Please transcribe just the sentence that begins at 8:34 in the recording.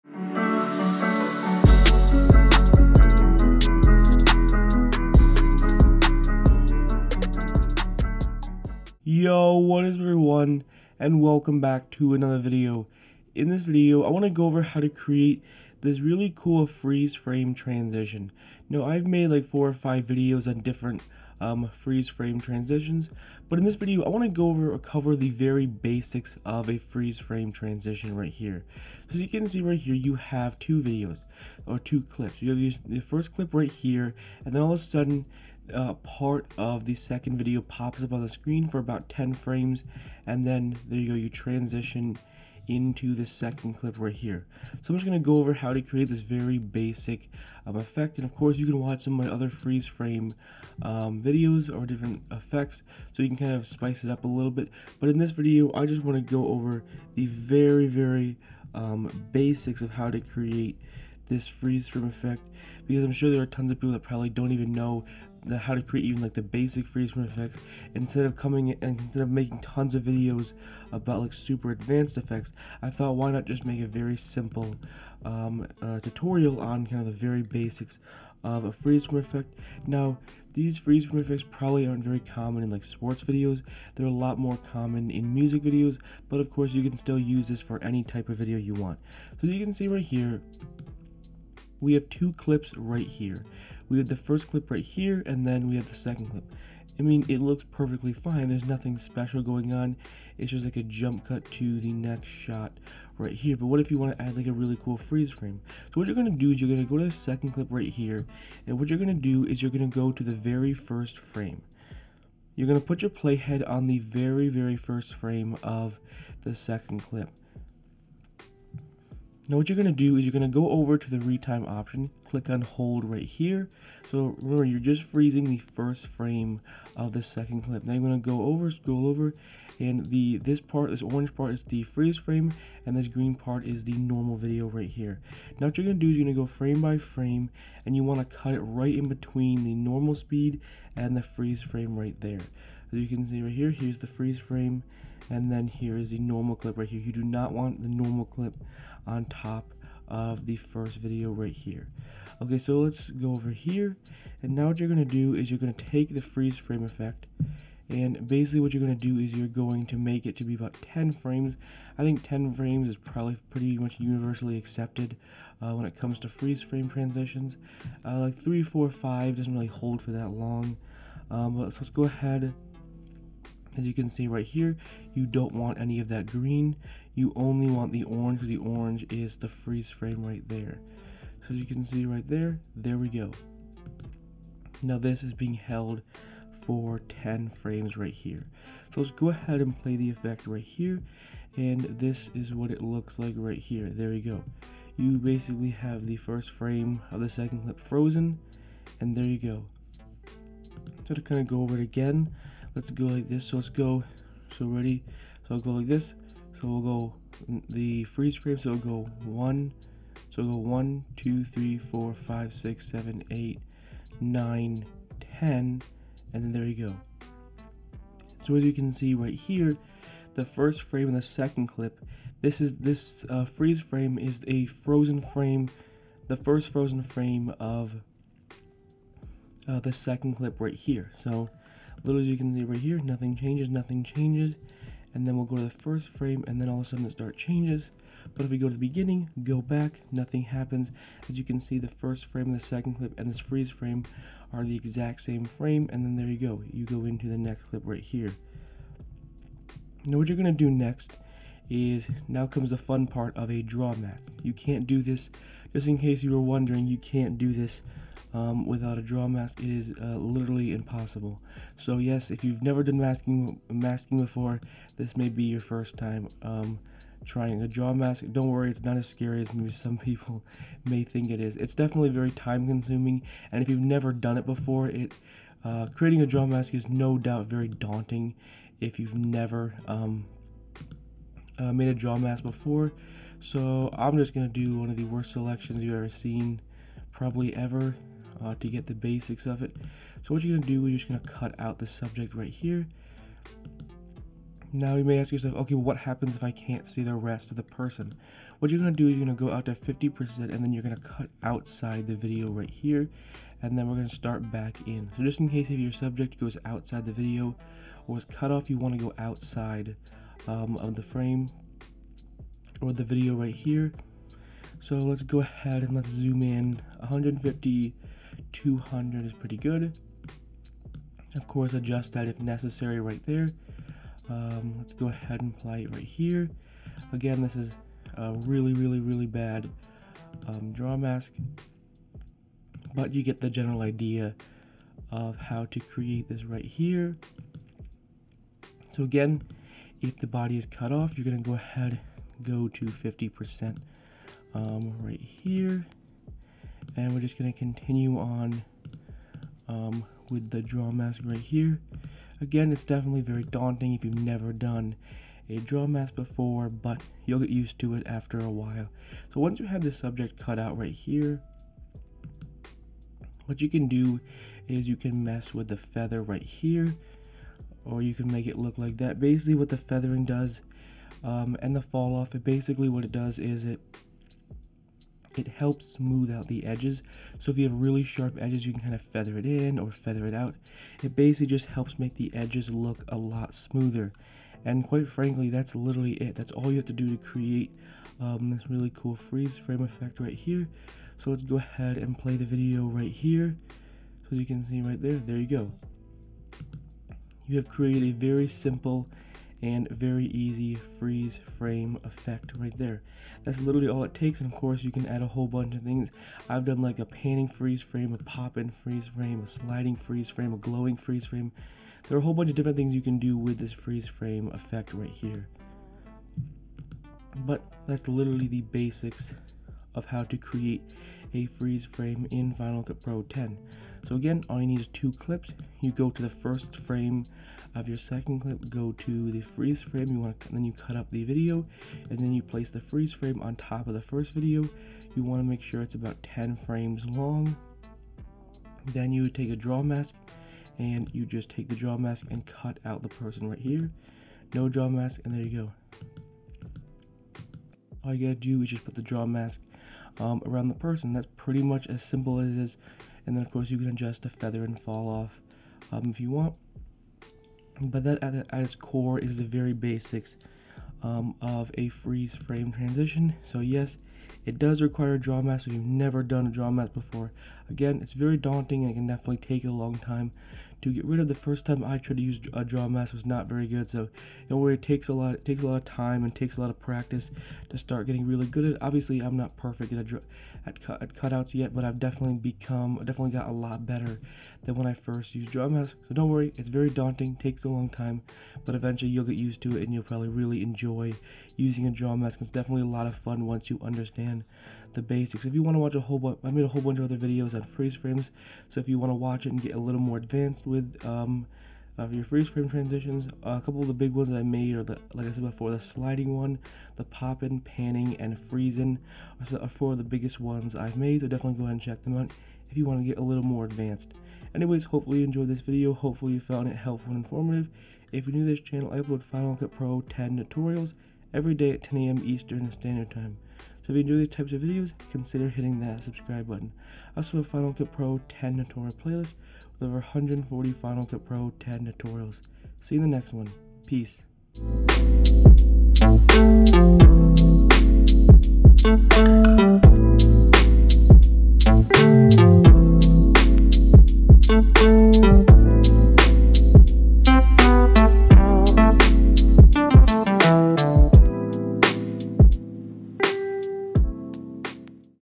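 Anyways, hopefully you enjoyed this video.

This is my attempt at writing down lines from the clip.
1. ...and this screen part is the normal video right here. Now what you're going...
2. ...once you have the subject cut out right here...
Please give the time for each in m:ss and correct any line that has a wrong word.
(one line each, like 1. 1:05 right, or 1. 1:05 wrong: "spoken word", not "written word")
1. 2:12 wrong: "green", not "screen"
2. 5:59 right.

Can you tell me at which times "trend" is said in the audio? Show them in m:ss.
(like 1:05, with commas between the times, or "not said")
not said.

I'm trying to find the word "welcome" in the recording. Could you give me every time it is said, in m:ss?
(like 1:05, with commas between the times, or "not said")
0:11.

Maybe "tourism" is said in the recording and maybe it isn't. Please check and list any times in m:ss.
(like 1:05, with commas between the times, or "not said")
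not said.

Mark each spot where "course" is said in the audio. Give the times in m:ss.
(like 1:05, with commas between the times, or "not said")
0:48, 1:26, 5:21, 6:44, 7:33.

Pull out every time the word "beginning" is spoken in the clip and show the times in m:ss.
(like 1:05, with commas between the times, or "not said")
3:58.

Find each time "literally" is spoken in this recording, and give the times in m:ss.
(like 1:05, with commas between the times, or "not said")
4:20, 6:25, 6:43, 6:58.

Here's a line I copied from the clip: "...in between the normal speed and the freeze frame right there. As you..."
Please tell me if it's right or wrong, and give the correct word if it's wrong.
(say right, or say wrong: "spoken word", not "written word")
right.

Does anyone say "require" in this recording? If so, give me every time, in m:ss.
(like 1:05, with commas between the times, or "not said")
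7:44.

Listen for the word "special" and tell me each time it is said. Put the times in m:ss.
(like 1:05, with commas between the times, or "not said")
1:38.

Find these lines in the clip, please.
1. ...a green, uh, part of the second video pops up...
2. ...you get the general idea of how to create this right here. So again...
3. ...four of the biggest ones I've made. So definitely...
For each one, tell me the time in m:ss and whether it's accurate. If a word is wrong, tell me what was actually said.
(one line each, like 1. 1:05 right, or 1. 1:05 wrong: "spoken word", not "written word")
1. 0:34 wrong: "sudden", not "green"
2. 5:33 right
3. 8:29 right.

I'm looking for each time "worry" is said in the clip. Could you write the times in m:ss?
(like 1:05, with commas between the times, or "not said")
4:28, 7:54, 8:06.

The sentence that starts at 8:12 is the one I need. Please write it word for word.
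It's definitely a lot of fun once you understand the basics.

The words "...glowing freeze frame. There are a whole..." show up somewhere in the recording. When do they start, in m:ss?
6:50.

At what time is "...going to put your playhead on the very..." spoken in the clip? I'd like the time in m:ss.
1:52.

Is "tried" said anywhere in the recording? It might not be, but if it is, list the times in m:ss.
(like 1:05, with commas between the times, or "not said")
7:51.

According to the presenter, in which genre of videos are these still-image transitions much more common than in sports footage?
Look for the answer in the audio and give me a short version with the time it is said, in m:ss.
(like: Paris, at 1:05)
music videos, at 1:25.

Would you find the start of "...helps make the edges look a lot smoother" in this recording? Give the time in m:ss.
6:21.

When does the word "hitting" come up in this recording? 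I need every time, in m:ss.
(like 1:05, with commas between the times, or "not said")
8:45.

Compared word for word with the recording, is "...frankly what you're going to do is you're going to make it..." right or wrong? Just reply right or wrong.
wrong.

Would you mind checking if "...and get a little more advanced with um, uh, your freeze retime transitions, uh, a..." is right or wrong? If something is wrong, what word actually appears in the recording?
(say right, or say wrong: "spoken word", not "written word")
wrong: "frame", not "retime".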